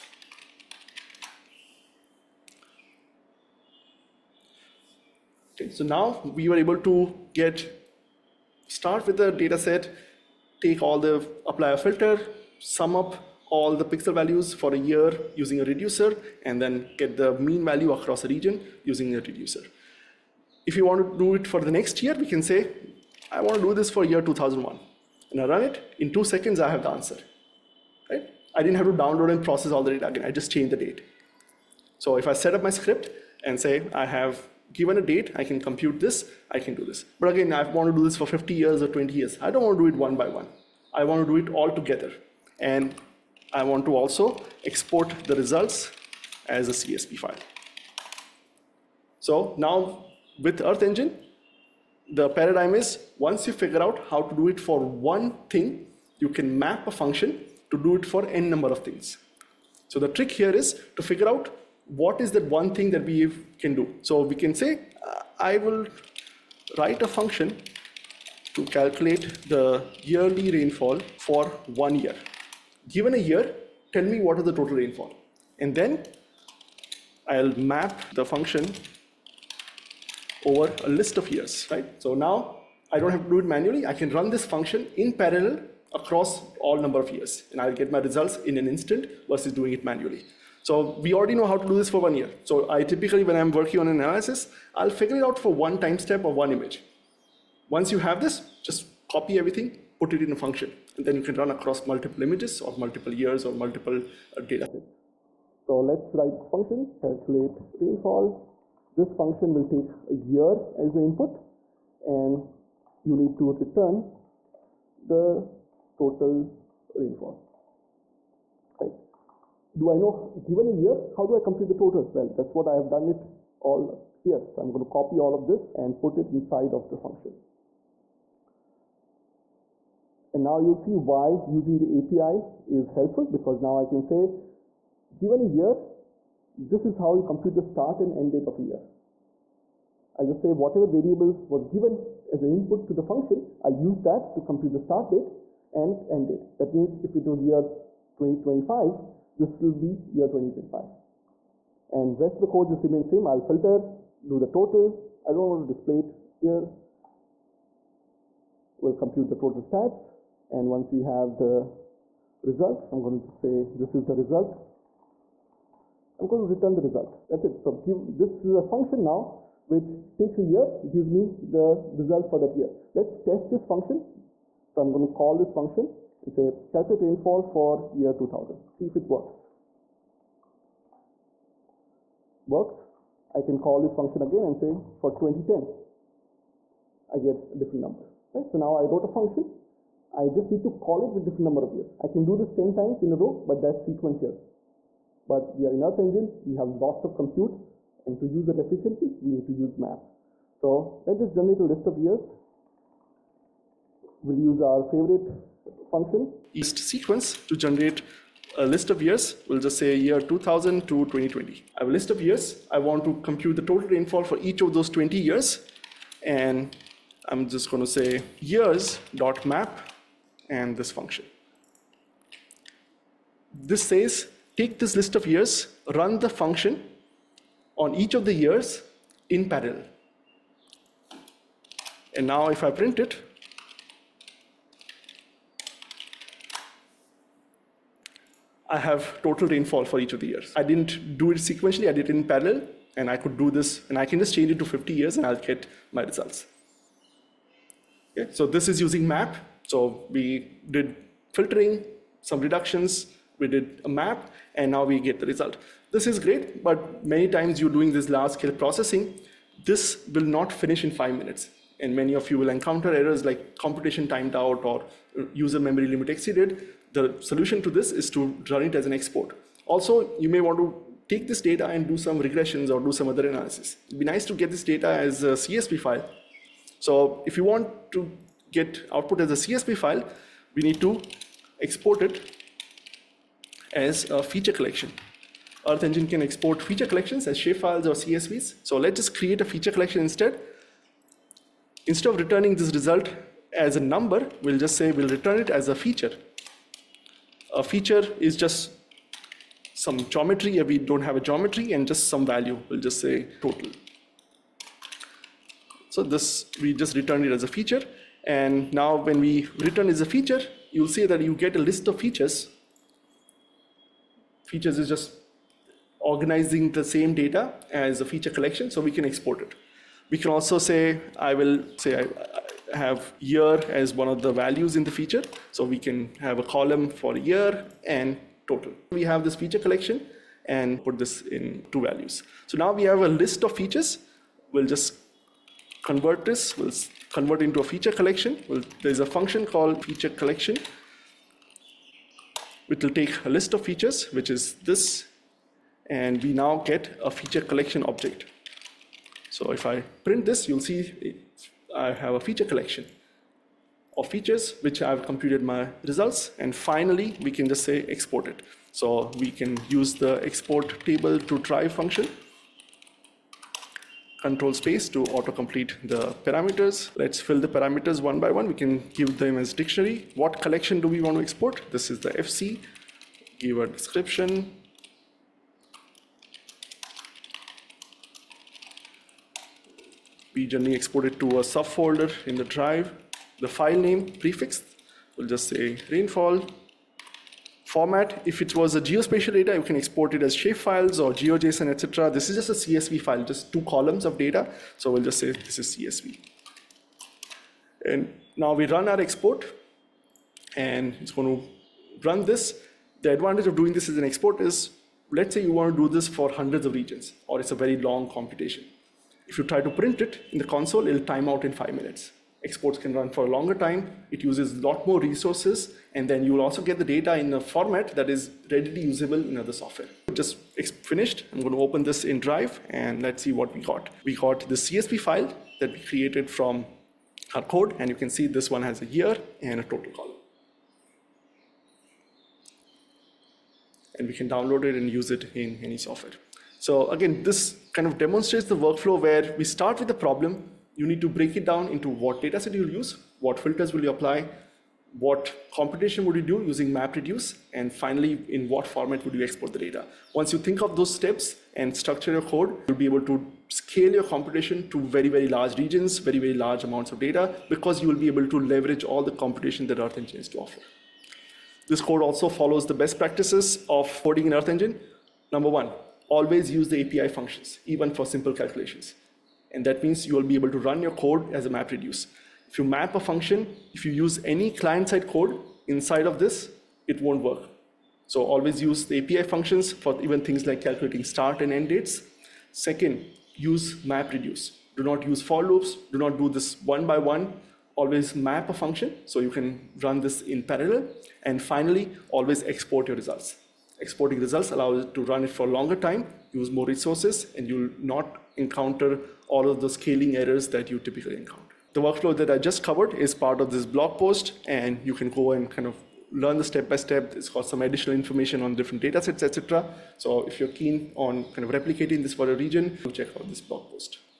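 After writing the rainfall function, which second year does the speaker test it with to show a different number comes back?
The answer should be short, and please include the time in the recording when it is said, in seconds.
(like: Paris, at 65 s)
2010, at 185 s.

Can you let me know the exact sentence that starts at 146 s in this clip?
That means if it was year 2025, this will be year 2025.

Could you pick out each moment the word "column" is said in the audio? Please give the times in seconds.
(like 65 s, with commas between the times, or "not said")
326 s, 393 s, 429 s.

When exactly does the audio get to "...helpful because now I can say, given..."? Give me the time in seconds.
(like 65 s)
132 s.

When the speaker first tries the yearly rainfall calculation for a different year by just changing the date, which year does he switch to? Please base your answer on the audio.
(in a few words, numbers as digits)
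2001.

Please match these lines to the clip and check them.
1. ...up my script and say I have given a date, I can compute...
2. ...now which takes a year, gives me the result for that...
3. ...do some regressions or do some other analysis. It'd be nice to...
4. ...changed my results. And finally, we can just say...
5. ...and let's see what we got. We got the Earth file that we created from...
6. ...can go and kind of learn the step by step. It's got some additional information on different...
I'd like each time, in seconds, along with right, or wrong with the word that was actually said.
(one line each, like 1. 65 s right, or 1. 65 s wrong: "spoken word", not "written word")
1. 32 s right
2. 169 s right
3. 271 s right
4. 355 s wrong: "computed", not "changed"
5. 422 s wrong: "CSV", not "Earth"
6. 504 s right.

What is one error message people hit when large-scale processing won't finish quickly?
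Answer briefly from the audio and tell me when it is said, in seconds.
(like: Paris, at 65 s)
computation timed out, at 263 s.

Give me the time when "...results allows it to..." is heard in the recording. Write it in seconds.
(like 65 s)
494 s.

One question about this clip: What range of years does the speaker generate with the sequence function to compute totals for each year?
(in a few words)
2000 to 2020.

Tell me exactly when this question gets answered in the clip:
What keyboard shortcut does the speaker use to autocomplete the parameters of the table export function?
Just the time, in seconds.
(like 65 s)
364 s.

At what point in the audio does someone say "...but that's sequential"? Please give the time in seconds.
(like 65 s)
193 s.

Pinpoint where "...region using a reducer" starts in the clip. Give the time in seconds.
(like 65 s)
18 s.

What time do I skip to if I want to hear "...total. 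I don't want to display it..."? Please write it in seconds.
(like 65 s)
154 s.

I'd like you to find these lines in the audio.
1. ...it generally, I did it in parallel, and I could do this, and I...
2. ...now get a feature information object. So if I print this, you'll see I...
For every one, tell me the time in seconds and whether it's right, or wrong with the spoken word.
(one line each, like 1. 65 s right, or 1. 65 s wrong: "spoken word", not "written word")
1. 241 s wrong: "sequentially", not "generally"
2. 346 s wrong: "collection", not "information".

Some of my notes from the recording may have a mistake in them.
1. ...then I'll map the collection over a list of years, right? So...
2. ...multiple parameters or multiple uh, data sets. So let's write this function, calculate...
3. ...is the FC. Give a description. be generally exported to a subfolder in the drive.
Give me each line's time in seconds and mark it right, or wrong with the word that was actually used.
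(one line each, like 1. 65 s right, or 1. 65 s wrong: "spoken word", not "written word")
1. 75 s wrong: "function", not "collection"
2. 102 s wrong: "years", not "parameters"
3. 371 s right.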